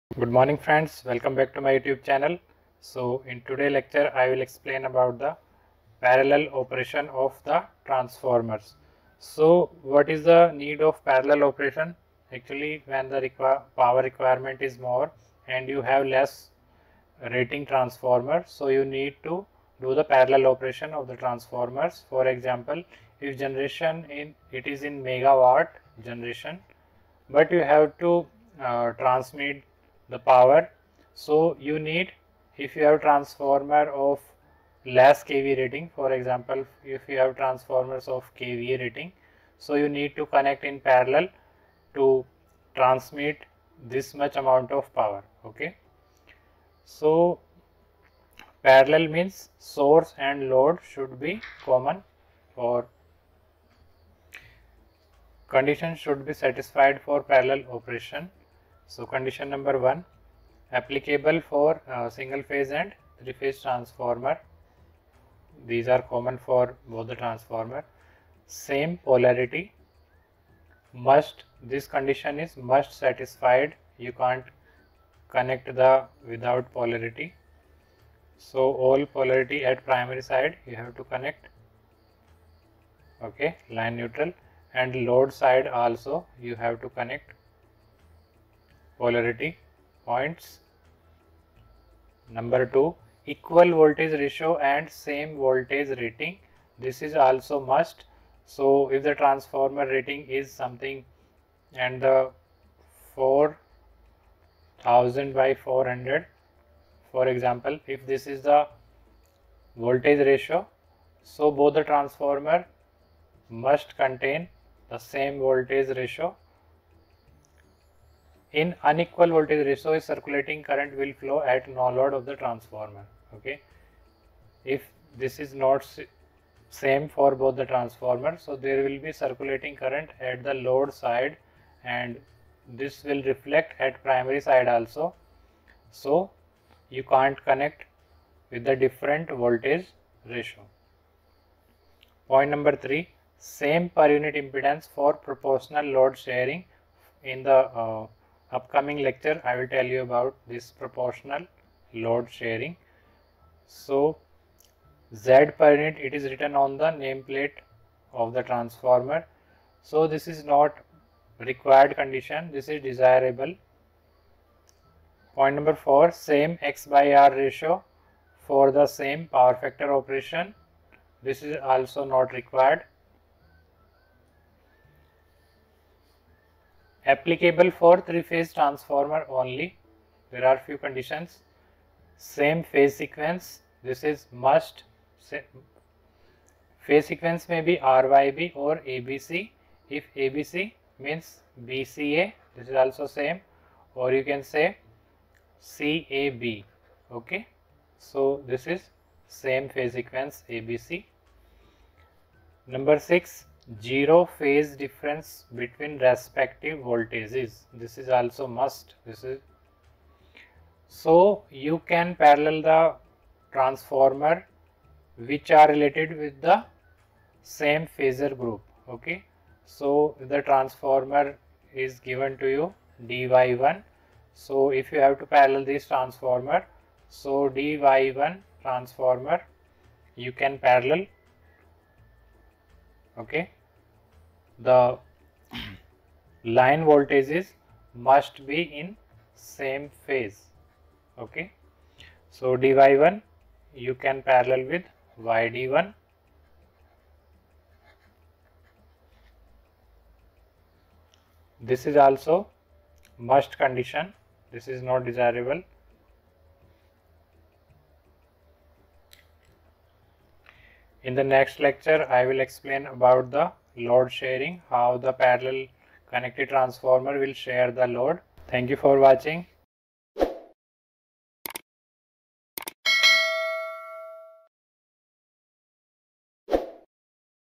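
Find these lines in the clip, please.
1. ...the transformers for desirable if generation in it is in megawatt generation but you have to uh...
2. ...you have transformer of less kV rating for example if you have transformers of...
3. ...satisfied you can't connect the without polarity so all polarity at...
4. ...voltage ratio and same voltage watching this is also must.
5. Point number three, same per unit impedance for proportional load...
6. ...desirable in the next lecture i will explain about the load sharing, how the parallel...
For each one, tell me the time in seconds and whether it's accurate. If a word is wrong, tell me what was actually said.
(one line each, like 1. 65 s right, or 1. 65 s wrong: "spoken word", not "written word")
1. 21 s wrong: "example", not "desirable"
2. 32 s right
3. 72 s right
4. 93 s wrong: "rating", not "watching"
5. 142 s right
6. 255 s right.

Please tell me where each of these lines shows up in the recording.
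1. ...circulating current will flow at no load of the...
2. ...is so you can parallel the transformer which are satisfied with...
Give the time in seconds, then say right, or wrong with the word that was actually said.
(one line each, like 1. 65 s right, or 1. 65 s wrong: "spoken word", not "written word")
1. 119 s right
2. 209 s wrong: "related", not "satisfied".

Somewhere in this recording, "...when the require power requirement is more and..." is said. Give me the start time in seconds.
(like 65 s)
12 s.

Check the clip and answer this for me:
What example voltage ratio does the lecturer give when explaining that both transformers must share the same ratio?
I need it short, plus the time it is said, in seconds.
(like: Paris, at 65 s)
4000/400, at 103 s.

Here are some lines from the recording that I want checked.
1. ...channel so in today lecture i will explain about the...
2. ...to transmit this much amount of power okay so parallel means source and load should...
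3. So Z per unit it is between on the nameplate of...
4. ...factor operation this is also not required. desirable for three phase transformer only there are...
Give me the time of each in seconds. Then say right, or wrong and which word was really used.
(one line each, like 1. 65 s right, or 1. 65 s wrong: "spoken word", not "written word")
1. 2 s right
2. 41 s right
3. 153 s wrong: "written", not "between"
4. 169 s wrong: "applicable", not "desirable".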